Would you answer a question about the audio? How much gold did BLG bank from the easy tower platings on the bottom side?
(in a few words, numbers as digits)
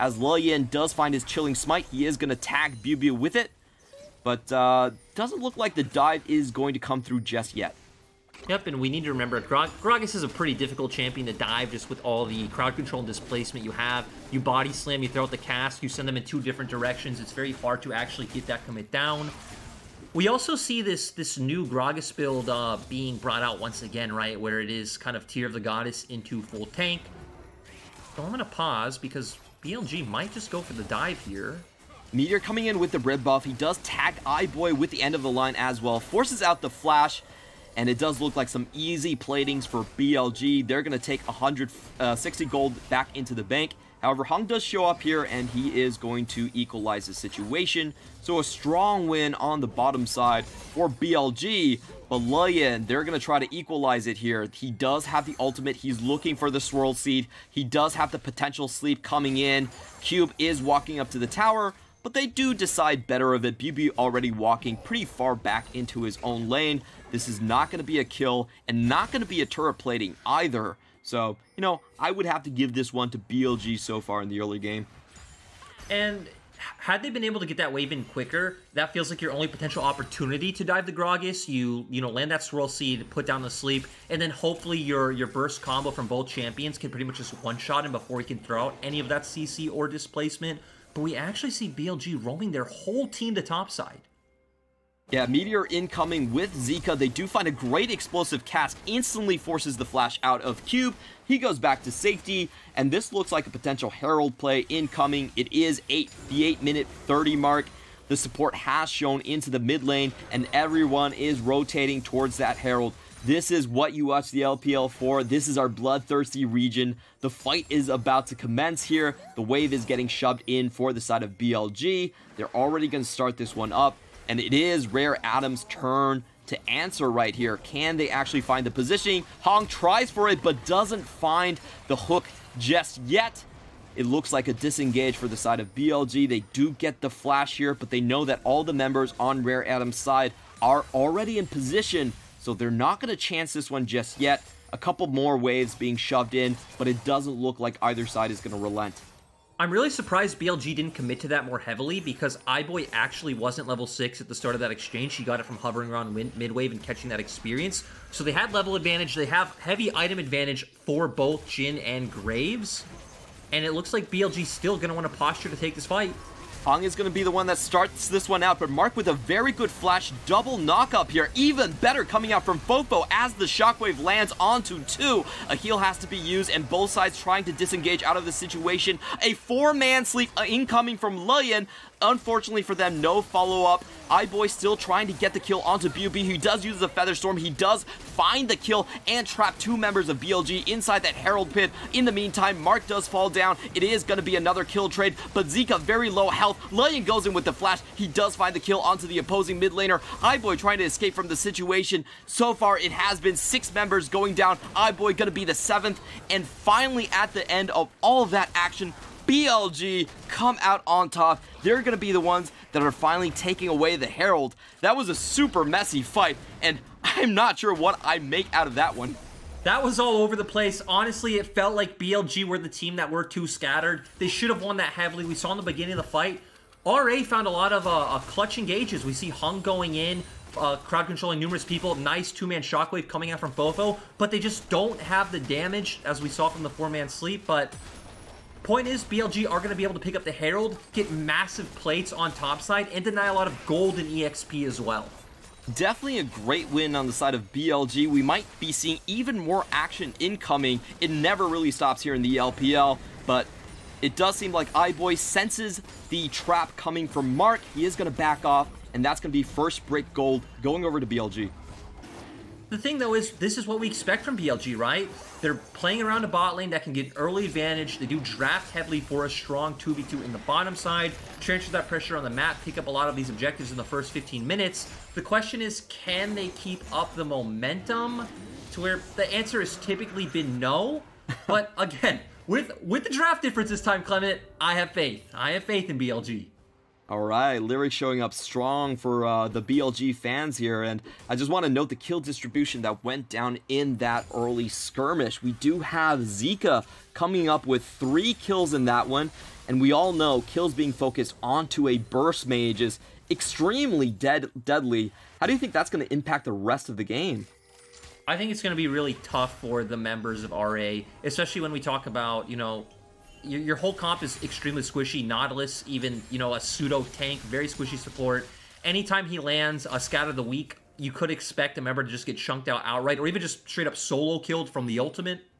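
160.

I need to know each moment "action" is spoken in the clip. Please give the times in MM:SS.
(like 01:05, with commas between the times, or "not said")
03:28, 04:09.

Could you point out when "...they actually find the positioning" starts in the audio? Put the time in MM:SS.
02:07.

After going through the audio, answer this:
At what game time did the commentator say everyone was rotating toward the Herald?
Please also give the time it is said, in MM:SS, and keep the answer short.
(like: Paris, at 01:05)
8:30, at 01:46.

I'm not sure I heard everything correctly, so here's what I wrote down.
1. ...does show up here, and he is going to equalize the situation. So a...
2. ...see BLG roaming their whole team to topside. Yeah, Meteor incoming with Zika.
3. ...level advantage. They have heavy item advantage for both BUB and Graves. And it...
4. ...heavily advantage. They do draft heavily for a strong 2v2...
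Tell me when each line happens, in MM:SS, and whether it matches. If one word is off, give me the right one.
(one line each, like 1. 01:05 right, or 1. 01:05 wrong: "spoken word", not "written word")
1. 00:44 right
2. 01:31 right
3. 02:38 wrong: "Jhin", not "BUB"
4. 04:27 wrong: "early", not "heavily".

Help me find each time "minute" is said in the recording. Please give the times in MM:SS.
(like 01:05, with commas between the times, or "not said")
01:46, 04:34.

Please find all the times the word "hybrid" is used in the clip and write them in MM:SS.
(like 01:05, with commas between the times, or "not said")
not said.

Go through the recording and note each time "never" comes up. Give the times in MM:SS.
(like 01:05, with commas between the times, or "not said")
04:11.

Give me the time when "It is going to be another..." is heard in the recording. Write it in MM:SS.
03:13.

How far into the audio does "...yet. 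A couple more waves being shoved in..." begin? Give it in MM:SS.
02:24.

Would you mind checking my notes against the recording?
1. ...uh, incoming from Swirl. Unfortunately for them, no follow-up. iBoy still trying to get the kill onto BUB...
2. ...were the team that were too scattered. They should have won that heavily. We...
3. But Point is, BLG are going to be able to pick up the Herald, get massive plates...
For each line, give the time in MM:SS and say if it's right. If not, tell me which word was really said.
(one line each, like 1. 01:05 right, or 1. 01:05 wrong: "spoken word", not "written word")
1. 03:00 wrong: "Lion", not "Swirl"
2. 03:42 right
3. 03:57 right.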